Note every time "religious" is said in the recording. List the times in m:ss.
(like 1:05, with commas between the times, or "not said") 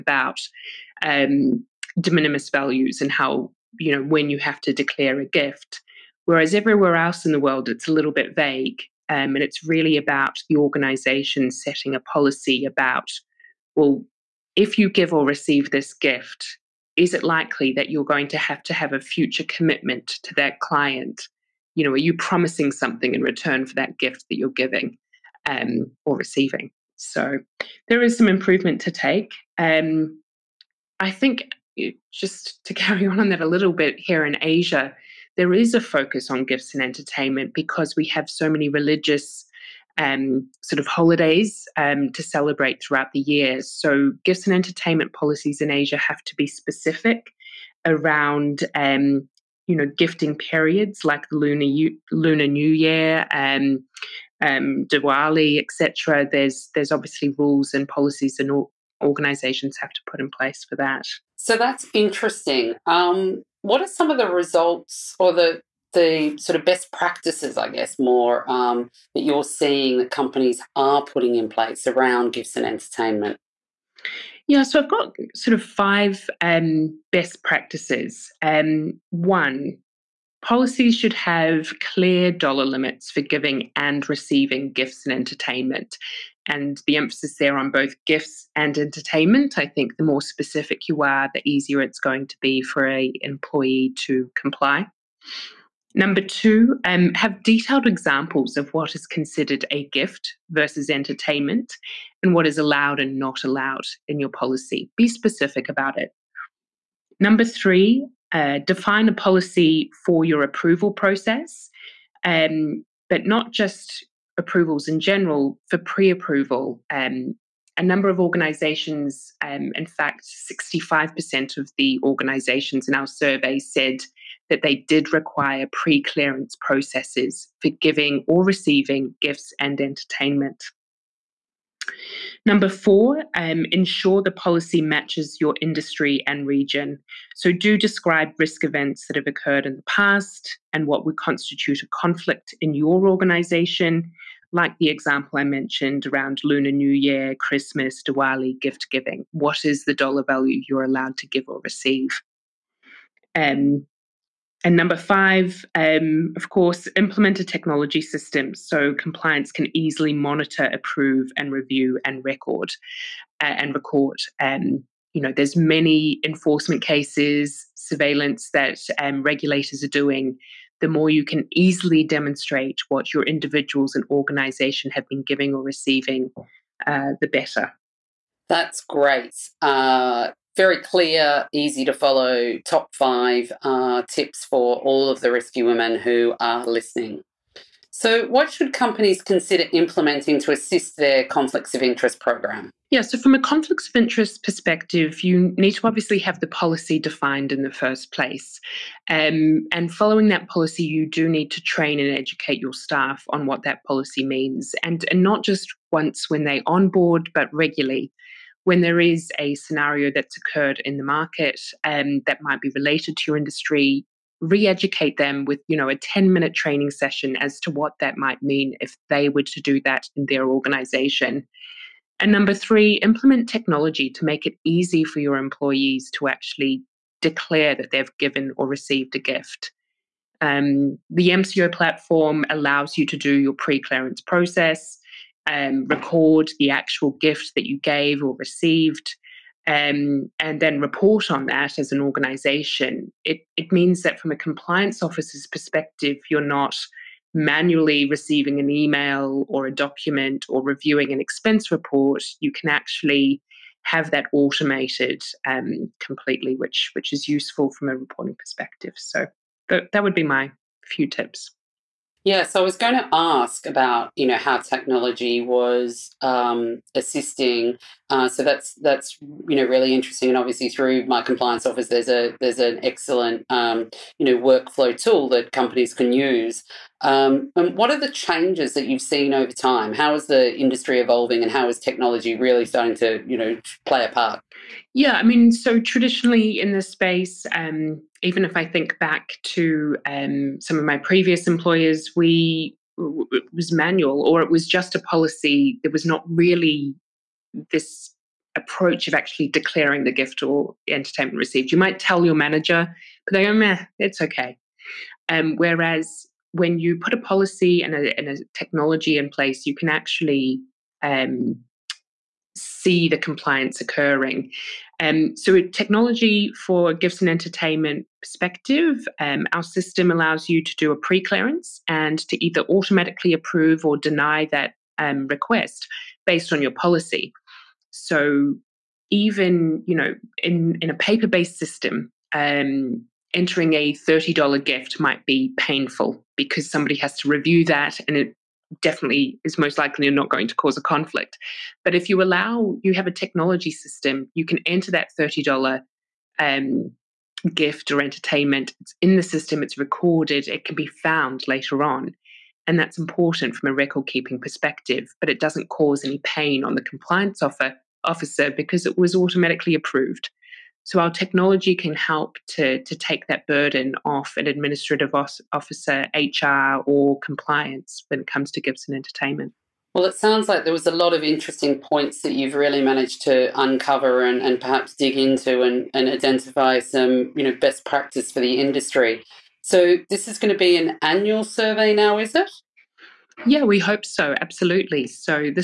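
0:38.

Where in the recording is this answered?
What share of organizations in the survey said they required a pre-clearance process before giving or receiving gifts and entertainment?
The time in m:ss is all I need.
2:00.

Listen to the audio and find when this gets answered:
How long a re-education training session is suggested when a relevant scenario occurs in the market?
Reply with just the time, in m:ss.
3:35.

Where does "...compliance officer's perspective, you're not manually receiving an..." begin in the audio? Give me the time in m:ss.
4:04.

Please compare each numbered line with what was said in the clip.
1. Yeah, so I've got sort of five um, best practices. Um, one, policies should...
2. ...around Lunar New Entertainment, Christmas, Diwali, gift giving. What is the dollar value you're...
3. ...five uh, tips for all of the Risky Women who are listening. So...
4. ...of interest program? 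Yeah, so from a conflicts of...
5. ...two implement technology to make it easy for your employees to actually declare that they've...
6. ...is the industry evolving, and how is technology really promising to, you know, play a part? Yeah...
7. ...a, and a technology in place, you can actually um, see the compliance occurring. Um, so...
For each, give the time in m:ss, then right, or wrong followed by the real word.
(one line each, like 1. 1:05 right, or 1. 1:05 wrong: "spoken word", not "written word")
1. 1:14 right
2. 2:26 wrong: "Year", not "Entertainment"
3. 3:02 right
4. 3:11 right
5. 3:42 wrong: "three", not "two"
6. 4:40 wrong: "starting", not "promising"
7. 5:07 right.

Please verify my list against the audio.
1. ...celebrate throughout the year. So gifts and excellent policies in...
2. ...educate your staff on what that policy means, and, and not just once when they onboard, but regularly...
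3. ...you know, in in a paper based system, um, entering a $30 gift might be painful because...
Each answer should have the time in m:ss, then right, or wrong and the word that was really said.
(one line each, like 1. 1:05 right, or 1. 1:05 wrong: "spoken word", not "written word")
1. 0:42 wrong: "entertainment", not "excellent"
2. 3:22 right
3. 5:29 right.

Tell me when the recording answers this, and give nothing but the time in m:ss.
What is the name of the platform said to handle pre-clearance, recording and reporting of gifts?
3:51.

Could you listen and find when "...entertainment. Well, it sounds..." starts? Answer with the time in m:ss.
6:08.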